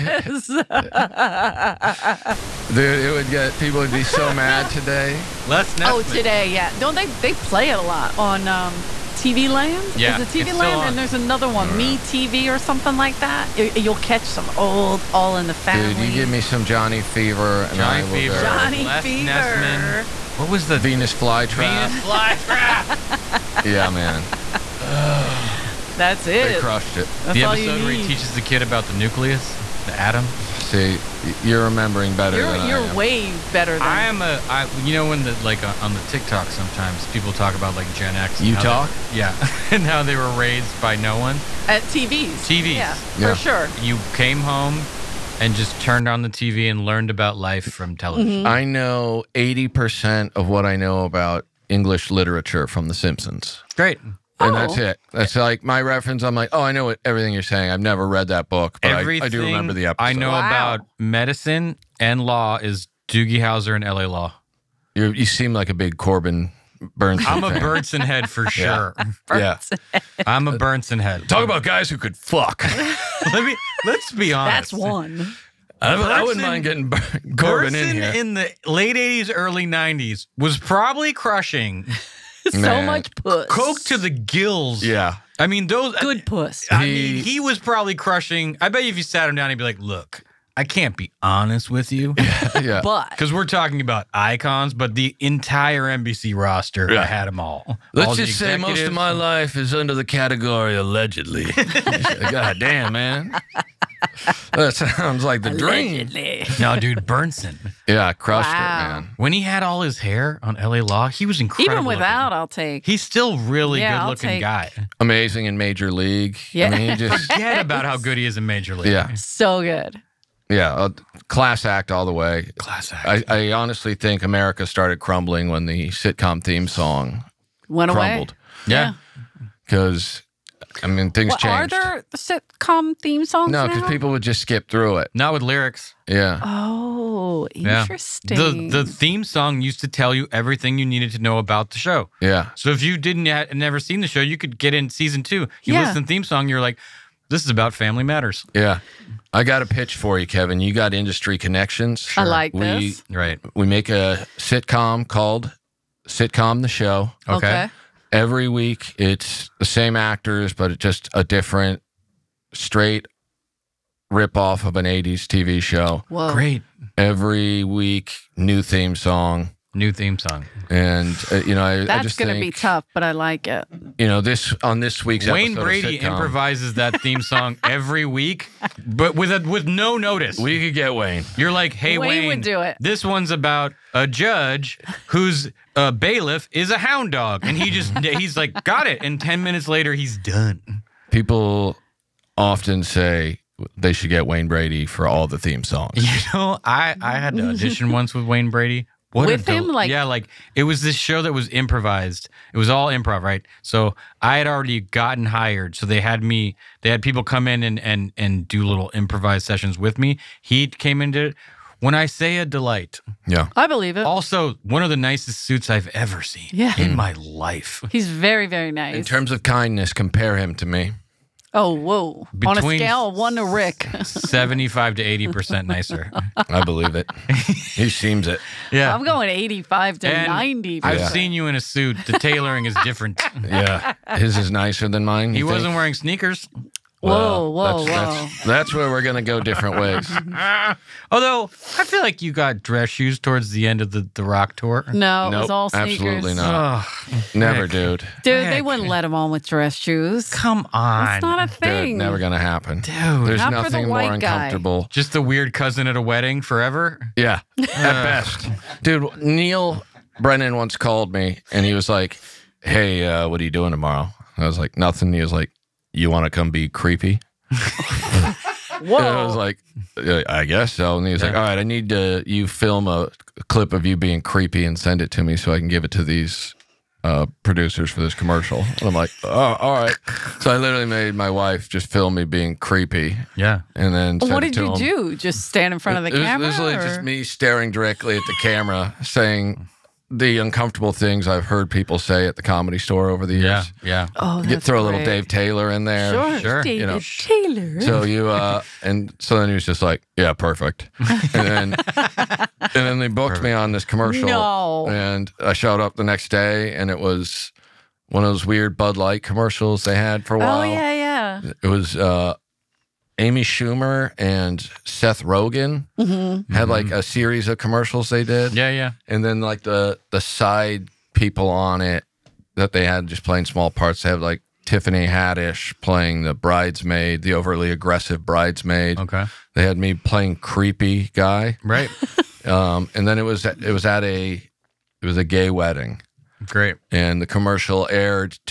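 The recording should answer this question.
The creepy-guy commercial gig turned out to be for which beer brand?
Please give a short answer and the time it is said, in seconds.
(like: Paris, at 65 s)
Bud Light, at 308 s.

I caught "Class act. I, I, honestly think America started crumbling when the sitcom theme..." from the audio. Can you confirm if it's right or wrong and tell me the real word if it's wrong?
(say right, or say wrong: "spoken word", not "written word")
right.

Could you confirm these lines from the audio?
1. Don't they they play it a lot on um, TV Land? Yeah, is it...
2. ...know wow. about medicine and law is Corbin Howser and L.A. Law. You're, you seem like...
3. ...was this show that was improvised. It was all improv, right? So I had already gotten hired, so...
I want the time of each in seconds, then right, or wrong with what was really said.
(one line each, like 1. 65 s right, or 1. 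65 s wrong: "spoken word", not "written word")
1. 6 s right
2. 60 s wrong: "Doogie", not "Corbin"
3. 200 s right.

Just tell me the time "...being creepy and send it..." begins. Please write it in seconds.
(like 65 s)
273 s.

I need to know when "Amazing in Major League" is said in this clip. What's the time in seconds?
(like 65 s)
115 s.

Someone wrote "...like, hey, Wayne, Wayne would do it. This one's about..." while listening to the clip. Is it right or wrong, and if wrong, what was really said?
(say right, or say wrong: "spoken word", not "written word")
right.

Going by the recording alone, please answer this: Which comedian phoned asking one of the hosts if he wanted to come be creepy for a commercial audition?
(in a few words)
Neal Brennan.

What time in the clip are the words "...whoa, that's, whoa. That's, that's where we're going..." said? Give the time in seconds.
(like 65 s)
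237 s.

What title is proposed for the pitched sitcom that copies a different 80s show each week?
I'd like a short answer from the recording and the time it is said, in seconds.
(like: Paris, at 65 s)
Sitcom the Show, at 156 s.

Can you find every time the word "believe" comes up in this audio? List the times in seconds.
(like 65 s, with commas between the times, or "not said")
213 s, 226 s.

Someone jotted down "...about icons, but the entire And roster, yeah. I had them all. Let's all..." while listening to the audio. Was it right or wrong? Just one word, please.
wrong.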